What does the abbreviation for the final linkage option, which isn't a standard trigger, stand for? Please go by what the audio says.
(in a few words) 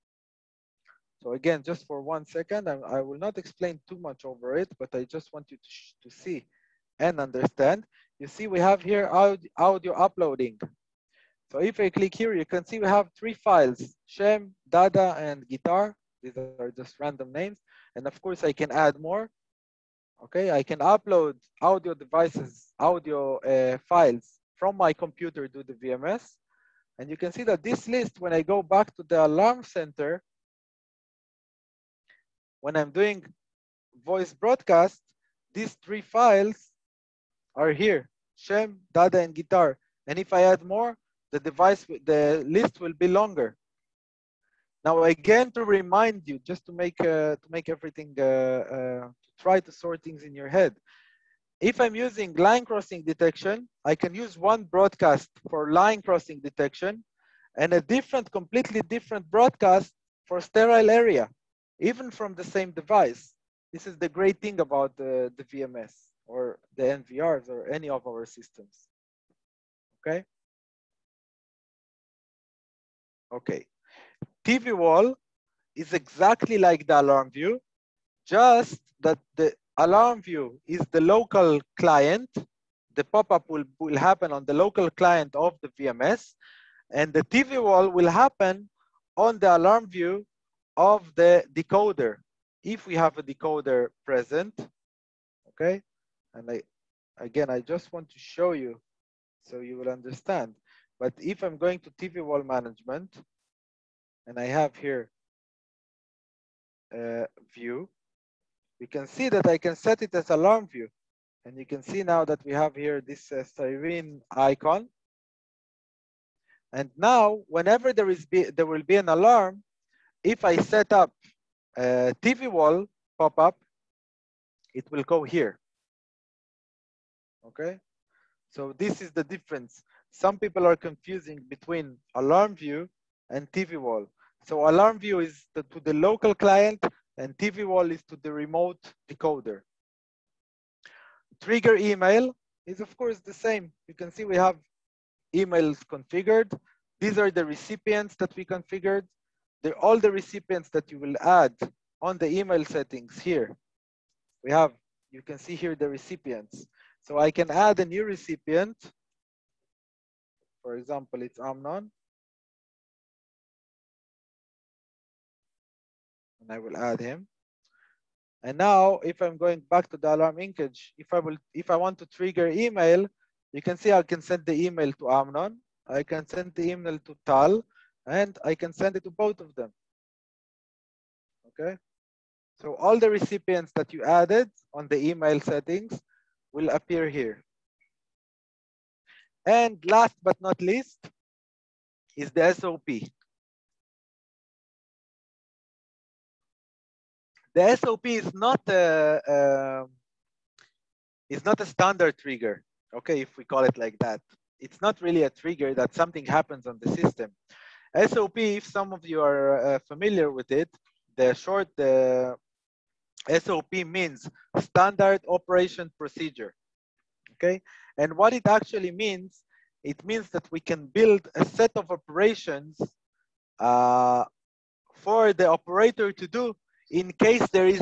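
standard operation procedure.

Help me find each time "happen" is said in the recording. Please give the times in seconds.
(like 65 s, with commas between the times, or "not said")
83 s, 88 s, 206 s.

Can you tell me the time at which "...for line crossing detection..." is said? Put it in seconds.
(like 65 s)
55 s.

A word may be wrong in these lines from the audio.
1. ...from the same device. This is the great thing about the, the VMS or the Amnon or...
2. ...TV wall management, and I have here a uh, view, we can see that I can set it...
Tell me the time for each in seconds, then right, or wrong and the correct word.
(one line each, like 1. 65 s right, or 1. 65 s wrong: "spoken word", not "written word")
1. 62 s wrong: "NVRs", not "Amnon"
2. 101 s right.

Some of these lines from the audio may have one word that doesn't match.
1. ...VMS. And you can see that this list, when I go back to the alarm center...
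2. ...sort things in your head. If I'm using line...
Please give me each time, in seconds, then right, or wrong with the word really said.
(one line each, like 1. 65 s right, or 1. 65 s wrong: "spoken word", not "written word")
1. 25 s right
2. 49 s right.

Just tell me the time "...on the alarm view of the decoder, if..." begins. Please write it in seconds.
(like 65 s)
89 s.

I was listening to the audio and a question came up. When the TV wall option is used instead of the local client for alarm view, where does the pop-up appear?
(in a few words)
the remote decoder.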